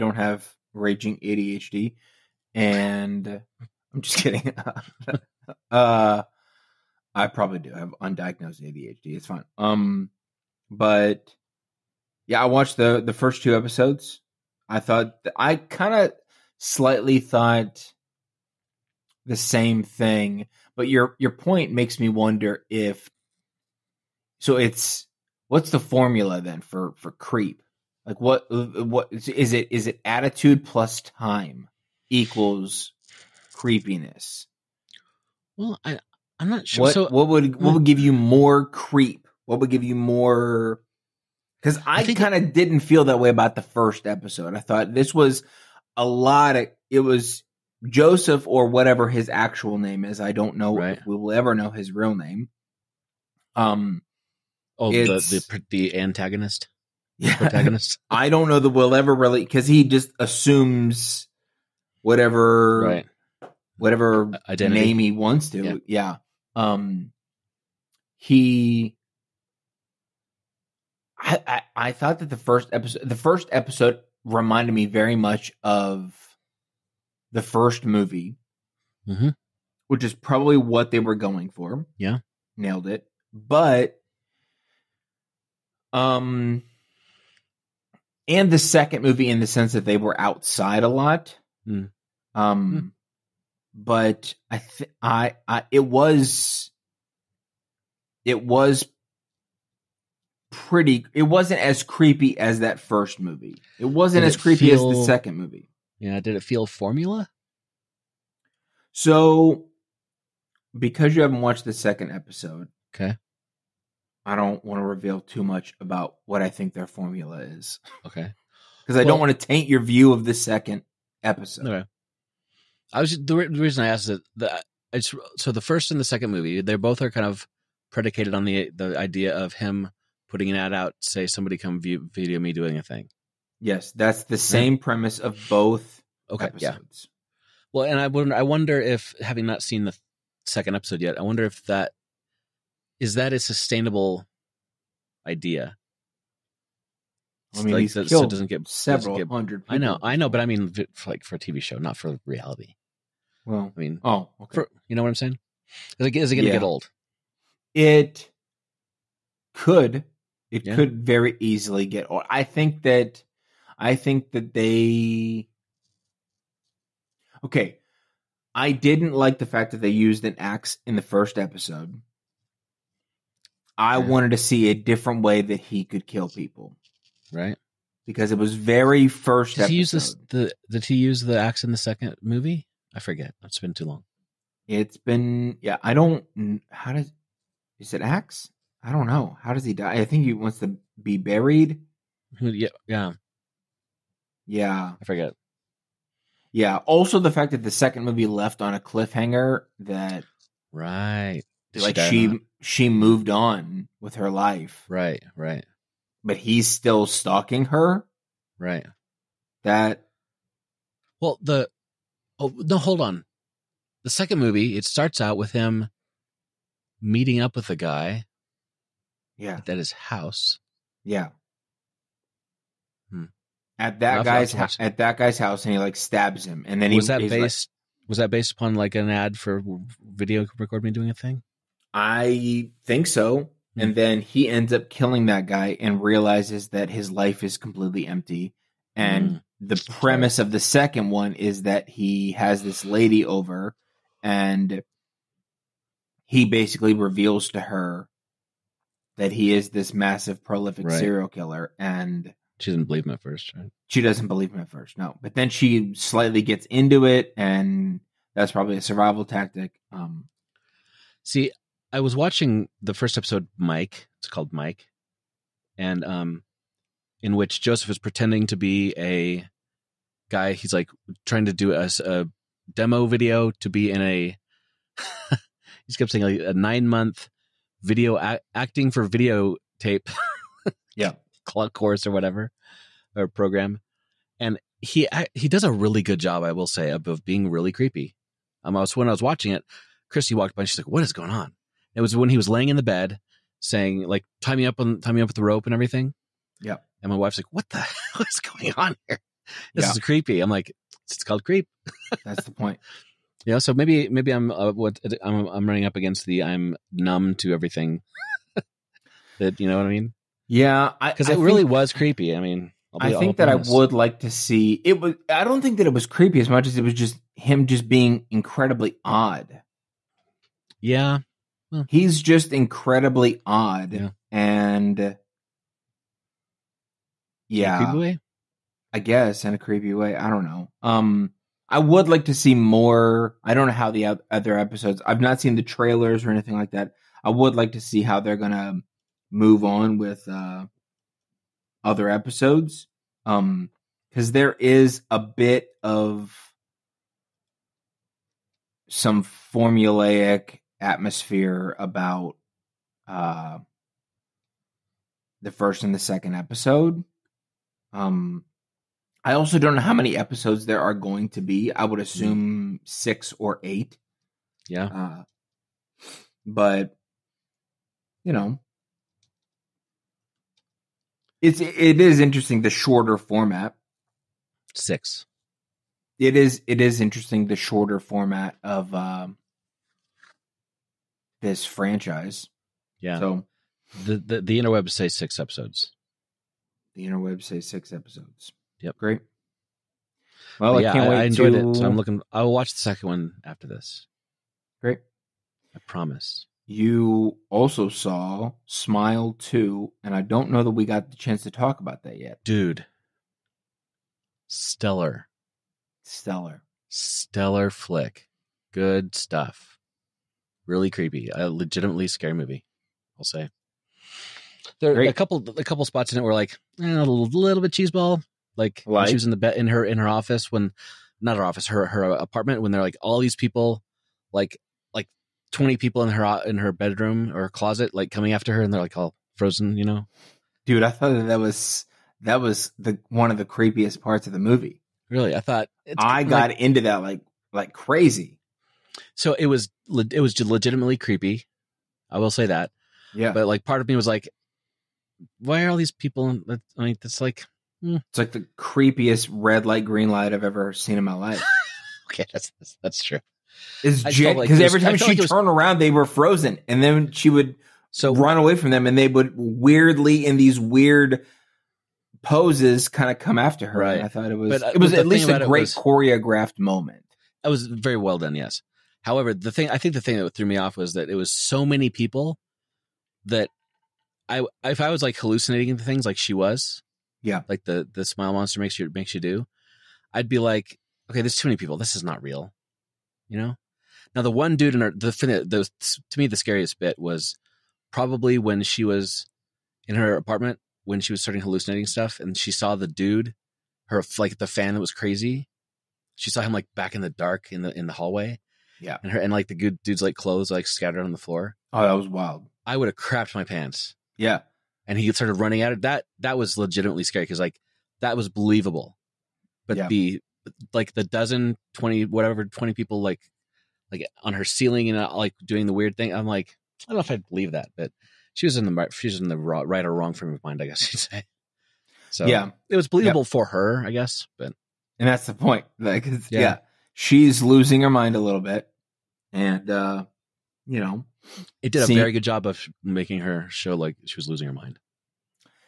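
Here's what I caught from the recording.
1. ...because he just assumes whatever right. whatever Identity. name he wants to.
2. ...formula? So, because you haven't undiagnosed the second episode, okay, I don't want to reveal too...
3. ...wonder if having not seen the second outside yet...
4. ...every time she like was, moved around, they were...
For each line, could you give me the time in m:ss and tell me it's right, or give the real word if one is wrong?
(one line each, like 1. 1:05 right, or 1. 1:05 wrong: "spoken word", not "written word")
1. 0:59 right
2. 1:46 wrong: "watched", not "undiagnosed"
3. 2:18 wrong: "episode", not "outside"
4. 7:34 wrong: "turned", not "moved".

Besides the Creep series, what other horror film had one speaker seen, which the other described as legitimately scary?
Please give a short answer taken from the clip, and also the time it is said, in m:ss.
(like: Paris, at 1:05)
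Smile 2, at 6:38.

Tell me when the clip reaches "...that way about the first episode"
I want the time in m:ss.
0:43.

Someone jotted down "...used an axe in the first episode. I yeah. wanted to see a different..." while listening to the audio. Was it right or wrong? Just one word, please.
right.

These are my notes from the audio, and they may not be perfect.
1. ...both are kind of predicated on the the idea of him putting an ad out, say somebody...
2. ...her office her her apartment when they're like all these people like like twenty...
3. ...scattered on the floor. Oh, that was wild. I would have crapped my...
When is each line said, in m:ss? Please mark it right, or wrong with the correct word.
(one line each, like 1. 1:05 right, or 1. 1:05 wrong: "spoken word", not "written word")
1. 2:06 right
2. 7:01 right
3. 8:20 right.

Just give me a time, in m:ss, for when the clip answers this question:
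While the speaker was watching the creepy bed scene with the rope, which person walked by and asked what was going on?
4:50.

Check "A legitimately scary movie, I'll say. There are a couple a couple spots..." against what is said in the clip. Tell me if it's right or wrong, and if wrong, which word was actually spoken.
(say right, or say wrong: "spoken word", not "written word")
right.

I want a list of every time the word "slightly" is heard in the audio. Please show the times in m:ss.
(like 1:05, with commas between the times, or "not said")
0:16, 4:15.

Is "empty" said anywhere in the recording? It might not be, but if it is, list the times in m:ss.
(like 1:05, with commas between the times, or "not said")
3:58.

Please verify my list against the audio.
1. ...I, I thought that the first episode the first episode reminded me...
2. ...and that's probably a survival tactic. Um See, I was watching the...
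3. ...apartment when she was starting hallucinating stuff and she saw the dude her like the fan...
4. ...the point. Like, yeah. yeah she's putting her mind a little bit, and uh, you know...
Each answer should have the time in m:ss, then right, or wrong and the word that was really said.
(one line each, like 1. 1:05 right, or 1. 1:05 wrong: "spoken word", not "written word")
1. 1:11 right
2. 4:17 right
3. 8:10 right
4. 8:45 wrong: "losing", not "putting".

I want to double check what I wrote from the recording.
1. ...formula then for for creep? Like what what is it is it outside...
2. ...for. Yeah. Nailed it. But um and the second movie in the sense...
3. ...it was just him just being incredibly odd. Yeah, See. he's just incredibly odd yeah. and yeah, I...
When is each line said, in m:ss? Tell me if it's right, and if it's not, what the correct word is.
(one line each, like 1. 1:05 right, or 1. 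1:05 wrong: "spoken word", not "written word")
1. 0:25 wrong: "attitude", not "outside"
2. 1:21 right
3. 5:16 wrong: "Hmm", not "See".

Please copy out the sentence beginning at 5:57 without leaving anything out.
Um, I also don't know how many episodes there are going to be.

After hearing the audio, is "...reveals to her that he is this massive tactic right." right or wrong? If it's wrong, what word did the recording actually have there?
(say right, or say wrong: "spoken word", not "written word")
wrong: "prolific", not "tactic".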